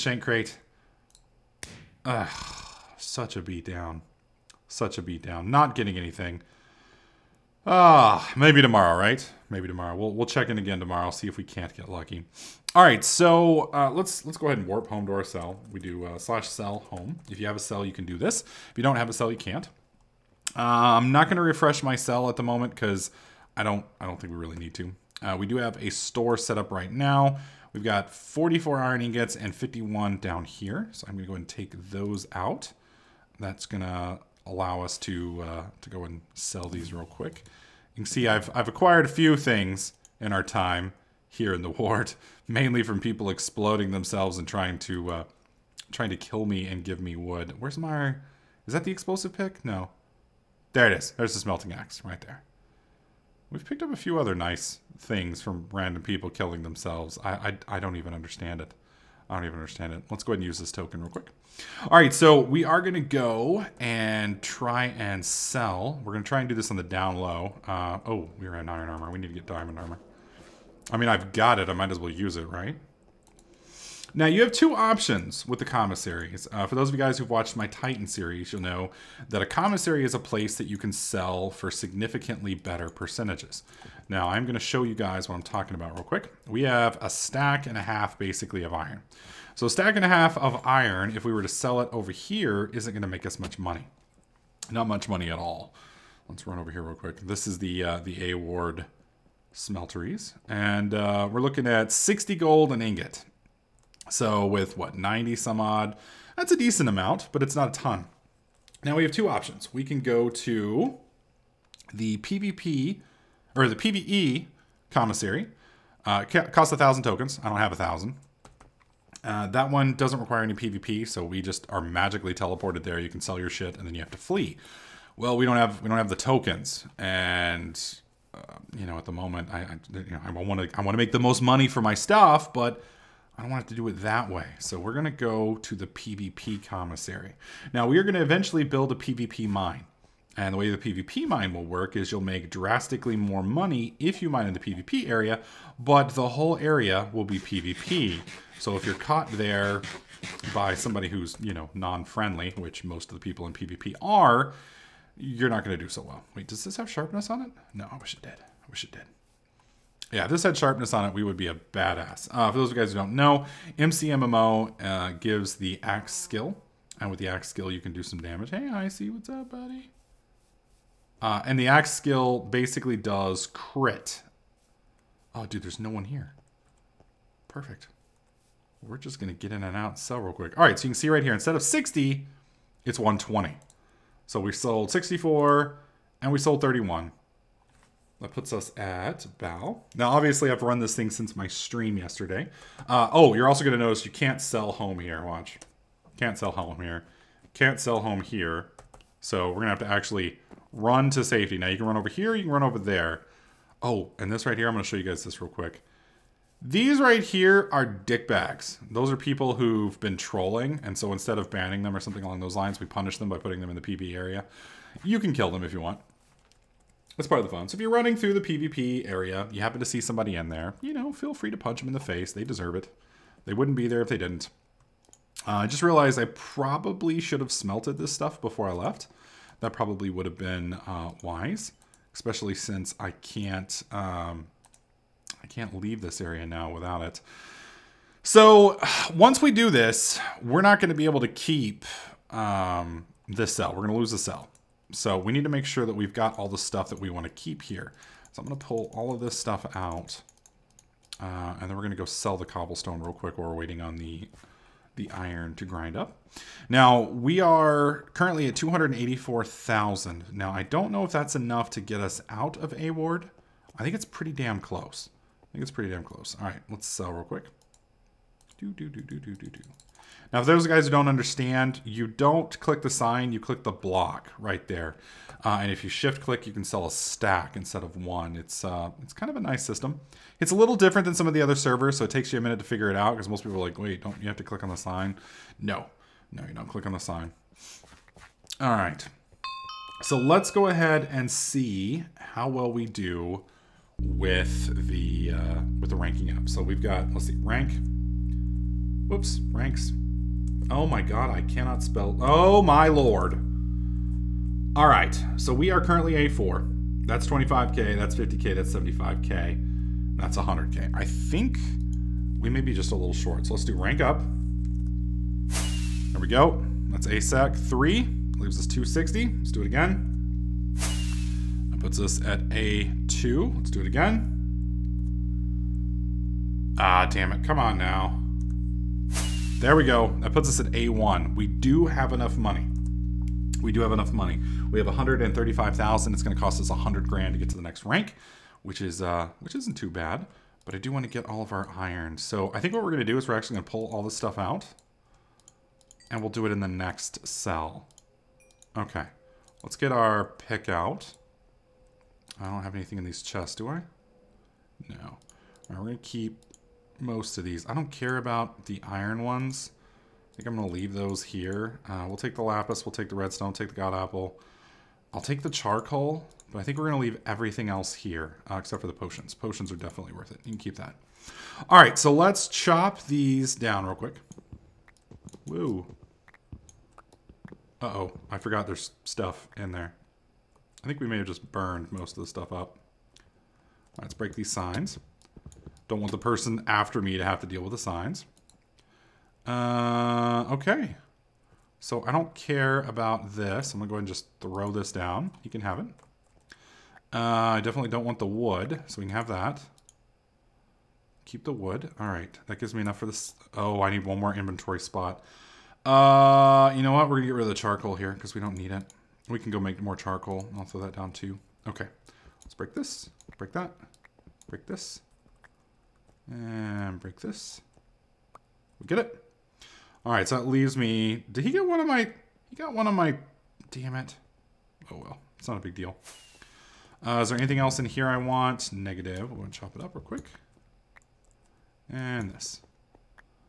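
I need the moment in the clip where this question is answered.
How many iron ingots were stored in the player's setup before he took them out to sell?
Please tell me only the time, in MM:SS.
00:28.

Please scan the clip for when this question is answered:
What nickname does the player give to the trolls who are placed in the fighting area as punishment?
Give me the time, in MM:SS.
03:27.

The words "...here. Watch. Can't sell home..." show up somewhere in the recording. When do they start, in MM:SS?
03:14.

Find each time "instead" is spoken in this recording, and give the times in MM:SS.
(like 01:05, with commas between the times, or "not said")
03:01, 03:31, 04:37.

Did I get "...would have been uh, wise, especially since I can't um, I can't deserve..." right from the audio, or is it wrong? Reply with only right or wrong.
wrong.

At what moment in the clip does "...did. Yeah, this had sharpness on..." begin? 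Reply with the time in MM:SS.
02:38.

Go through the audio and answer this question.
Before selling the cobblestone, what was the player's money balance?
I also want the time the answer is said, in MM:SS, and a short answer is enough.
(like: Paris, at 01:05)
284,000, at 04:18.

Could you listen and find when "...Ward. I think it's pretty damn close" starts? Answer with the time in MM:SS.
04:22.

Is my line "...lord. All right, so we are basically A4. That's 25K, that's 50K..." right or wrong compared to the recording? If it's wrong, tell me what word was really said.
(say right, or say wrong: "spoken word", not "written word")
wrong: "currently", not "basically".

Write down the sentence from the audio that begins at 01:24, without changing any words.
Now, I'm going to show you guys what I'm talking about real quick.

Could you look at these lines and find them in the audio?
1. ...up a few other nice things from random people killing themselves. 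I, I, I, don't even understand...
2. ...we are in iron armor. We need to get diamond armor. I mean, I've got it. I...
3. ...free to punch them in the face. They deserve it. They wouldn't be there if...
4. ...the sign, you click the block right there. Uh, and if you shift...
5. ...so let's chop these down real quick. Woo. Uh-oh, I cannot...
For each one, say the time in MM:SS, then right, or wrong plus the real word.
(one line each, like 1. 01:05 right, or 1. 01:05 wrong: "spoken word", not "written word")
1. 00:53 right
2. 01:08 right
3. 03:41 right
4. 04:32 right
5. 06:11 wrong: "forgot", not "cannot".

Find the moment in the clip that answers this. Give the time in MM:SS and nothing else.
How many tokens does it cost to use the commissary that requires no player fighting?
01:56.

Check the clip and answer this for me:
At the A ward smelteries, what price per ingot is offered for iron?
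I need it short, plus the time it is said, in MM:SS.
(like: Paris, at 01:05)
60 gold, at 01:41.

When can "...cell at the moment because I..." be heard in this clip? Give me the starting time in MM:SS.
00:21.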